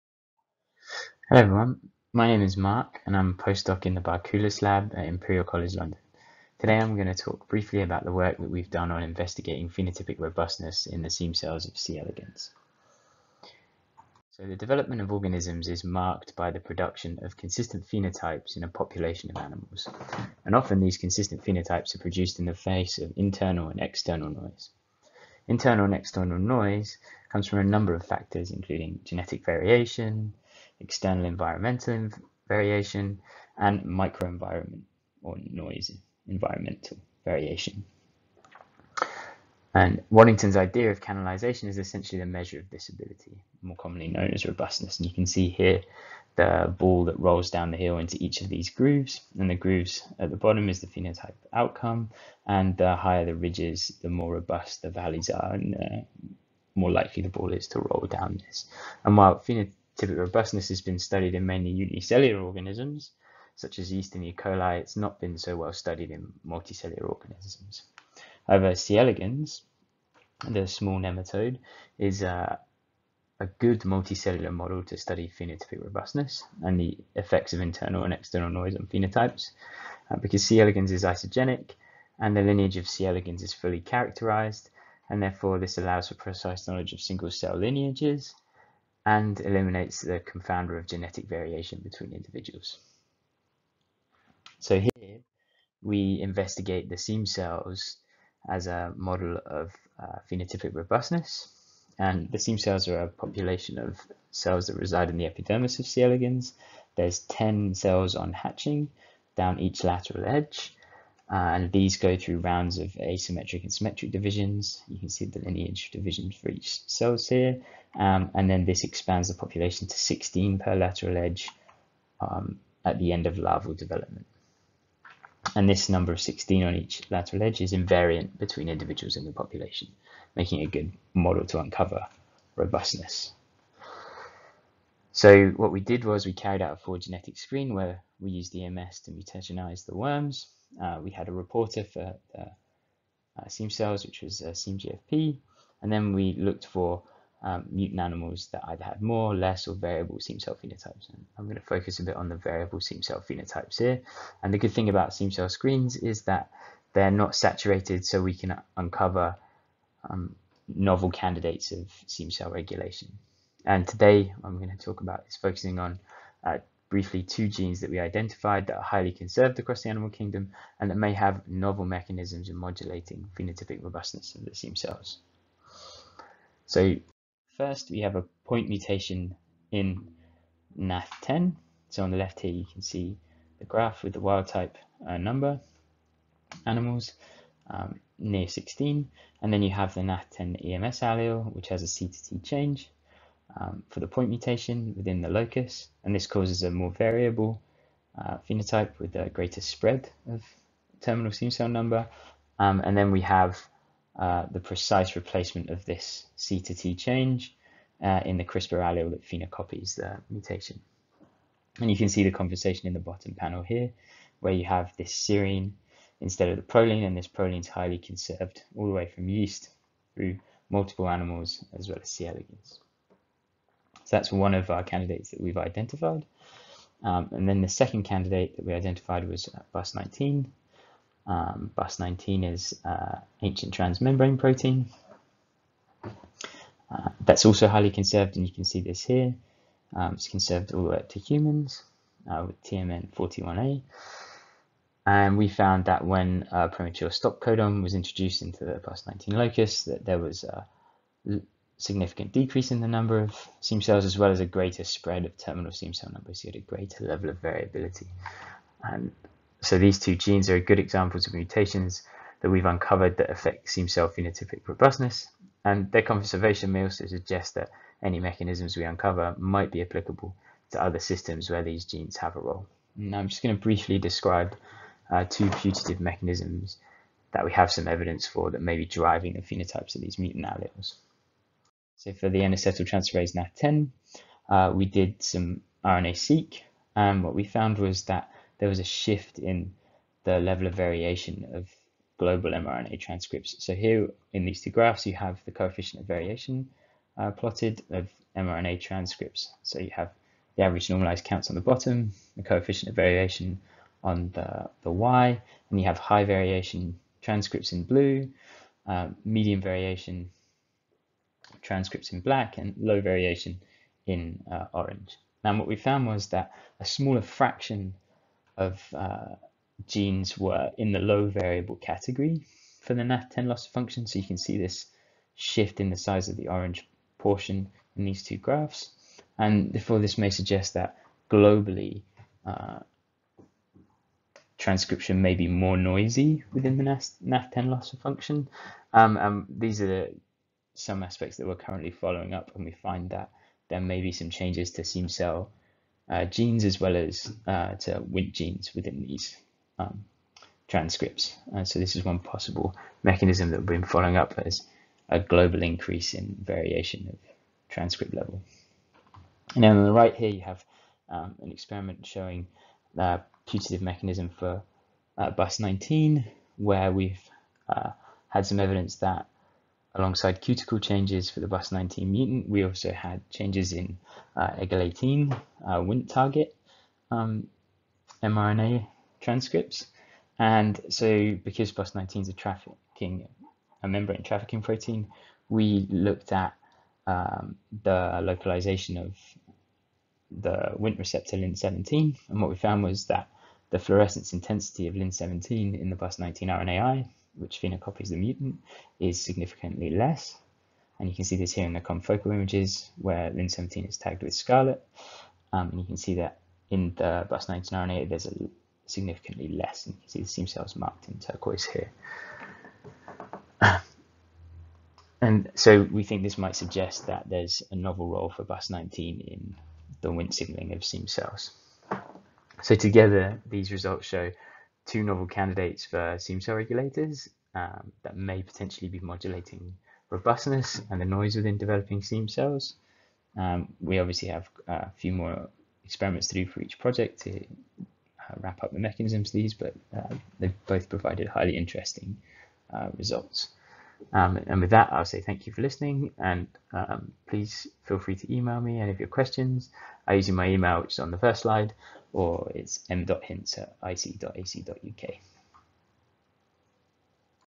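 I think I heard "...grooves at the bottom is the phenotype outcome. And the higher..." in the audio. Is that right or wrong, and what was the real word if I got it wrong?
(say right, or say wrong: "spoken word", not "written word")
right.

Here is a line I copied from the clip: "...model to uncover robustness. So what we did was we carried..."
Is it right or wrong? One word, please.
right.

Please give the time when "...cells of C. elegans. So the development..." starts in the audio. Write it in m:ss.
0:11.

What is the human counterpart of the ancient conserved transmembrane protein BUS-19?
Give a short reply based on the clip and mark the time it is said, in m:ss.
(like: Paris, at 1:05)
TMN 41A, at 4:02.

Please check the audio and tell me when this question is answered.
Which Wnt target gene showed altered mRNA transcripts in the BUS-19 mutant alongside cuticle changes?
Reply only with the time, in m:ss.
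6:14.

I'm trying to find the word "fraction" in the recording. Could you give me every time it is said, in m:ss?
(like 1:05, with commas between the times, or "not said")
5:17.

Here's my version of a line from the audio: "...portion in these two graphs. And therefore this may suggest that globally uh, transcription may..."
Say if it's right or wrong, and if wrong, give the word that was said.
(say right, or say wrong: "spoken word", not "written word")
right.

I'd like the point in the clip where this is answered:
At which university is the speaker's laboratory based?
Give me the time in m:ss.
0:05.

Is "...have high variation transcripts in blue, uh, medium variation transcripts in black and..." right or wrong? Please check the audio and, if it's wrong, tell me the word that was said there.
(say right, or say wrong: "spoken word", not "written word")
right.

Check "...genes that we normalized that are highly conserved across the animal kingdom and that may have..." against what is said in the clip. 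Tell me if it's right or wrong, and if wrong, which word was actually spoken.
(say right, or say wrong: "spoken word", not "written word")
wrong: "identified", not "normalized".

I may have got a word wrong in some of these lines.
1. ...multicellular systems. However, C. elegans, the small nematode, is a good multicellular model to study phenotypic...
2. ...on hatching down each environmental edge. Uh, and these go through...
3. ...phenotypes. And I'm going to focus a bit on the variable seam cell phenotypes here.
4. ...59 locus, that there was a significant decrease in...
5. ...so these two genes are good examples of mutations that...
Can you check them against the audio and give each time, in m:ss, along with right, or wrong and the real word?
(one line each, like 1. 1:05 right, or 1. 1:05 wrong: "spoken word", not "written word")
1. 1:06 wrong: "organisms", not "systems"
2. 1:48 wrong: "lateral", not "environmental"
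3. 2:30 right
4. 4:09 wrong: "19", not "59"
5. 4:19 right.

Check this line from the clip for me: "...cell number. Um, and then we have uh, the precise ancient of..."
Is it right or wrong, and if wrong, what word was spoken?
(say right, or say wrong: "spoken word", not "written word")
wrong: "replacement", not "ancient".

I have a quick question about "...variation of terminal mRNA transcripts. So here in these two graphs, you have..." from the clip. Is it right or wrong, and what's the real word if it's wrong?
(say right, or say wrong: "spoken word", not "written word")
wrong: "global", not "terminal".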